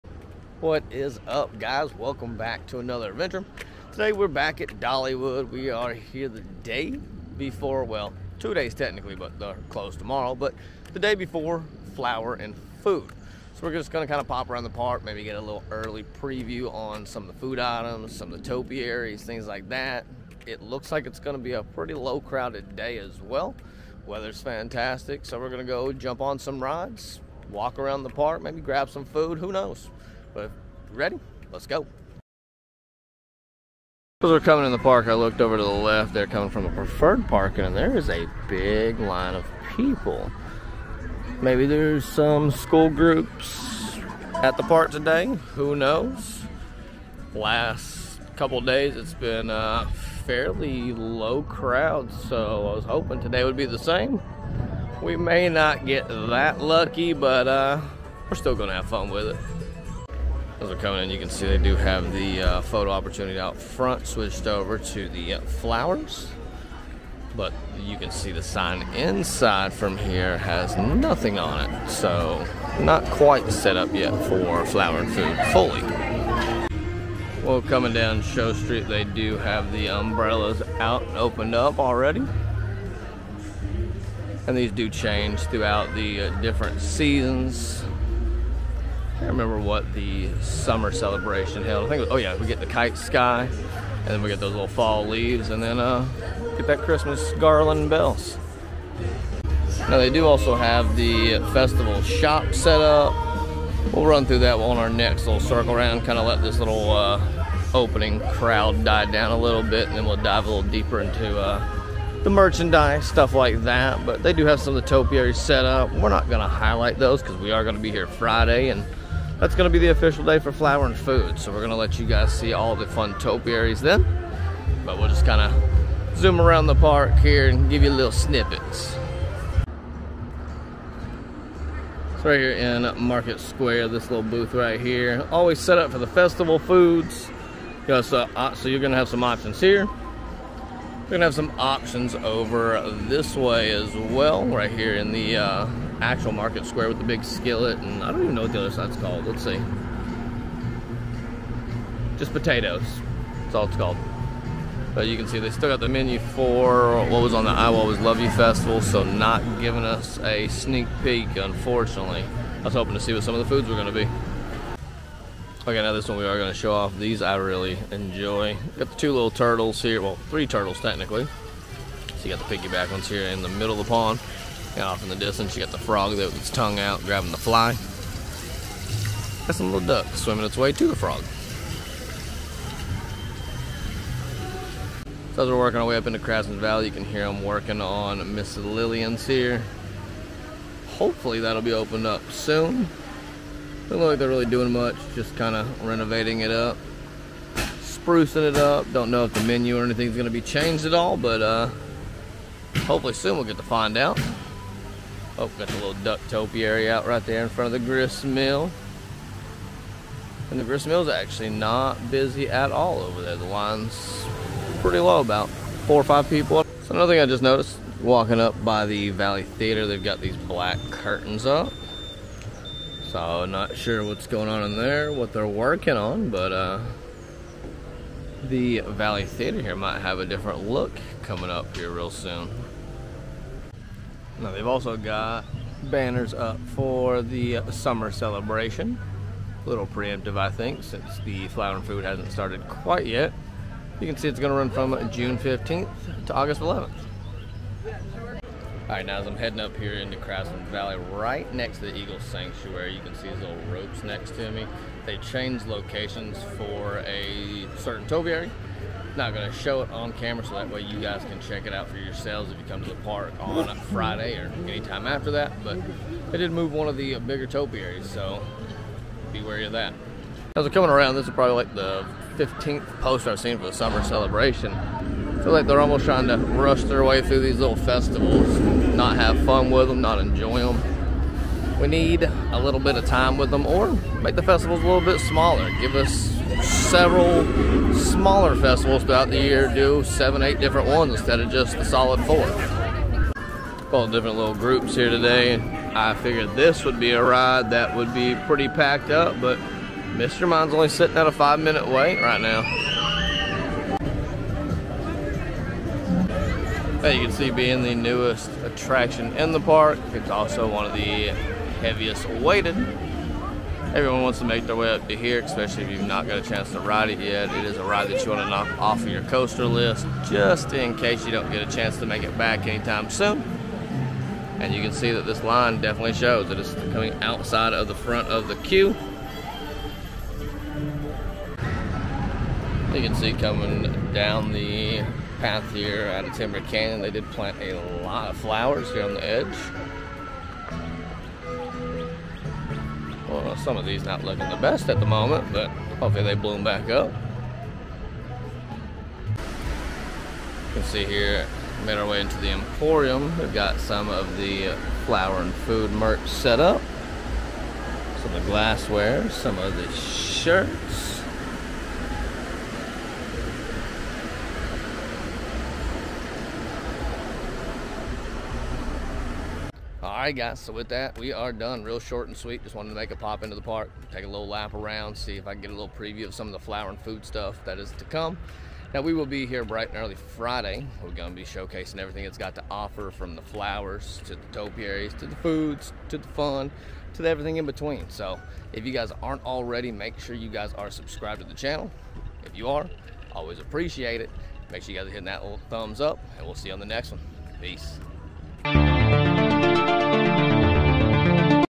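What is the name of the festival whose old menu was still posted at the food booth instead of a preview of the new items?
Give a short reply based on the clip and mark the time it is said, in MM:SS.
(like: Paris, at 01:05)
I Always Love You Festival, at 02:37.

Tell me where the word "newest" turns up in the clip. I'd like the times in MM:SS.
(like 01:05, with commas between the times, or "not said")
05:07.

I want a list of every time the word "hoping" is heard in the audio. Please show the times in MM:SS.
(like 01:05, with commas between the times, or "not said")
00:52, 02:42.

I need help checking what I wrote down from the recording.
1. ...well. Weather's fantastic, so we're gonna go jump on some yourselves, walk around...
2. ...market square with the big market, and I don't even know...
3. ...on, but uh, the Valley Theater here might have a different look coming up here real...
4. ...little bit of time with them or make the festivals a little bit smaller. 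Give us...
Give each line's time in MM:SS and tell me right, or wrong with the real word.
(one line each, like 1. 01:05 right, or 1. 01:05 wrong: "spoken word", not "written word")
1. 00:23 wrong: "rides", not "yourselves"
2. 02:26 wrong: "skillet", not "market"
3. 03:45 right
4. 04:42 right.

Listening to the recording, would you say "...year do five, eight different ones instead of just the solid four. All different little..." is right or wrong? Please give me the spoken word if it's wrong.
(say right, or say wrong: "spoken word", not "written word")
wrong: "seven", not "five".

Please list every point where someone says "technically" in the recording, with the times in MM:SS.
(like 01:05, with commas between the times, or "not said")
00:08, 02:50.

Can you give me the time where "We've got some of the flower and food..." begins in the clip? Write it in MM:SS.
05:53.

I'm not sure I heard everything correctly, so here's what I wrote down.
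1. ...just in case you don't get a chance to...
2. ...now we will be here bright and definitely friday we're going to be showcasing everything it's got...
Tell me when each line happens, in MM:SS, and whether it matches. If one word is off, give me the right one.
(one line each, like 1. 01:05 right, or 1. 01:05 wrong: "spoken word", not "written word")
1. 05:20 right
2. 06:18 wrong: "early", not "definitely".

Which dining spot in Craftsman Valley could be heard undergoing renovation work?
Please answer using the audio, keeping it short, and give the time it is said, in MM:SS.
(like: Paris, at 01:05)
Miss Lillian's, at 03:08.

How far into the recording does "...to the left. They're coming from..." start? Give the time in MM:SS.
00:35.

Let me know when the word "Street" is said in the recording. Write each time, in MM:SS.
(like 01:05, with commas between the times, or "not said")
01:18.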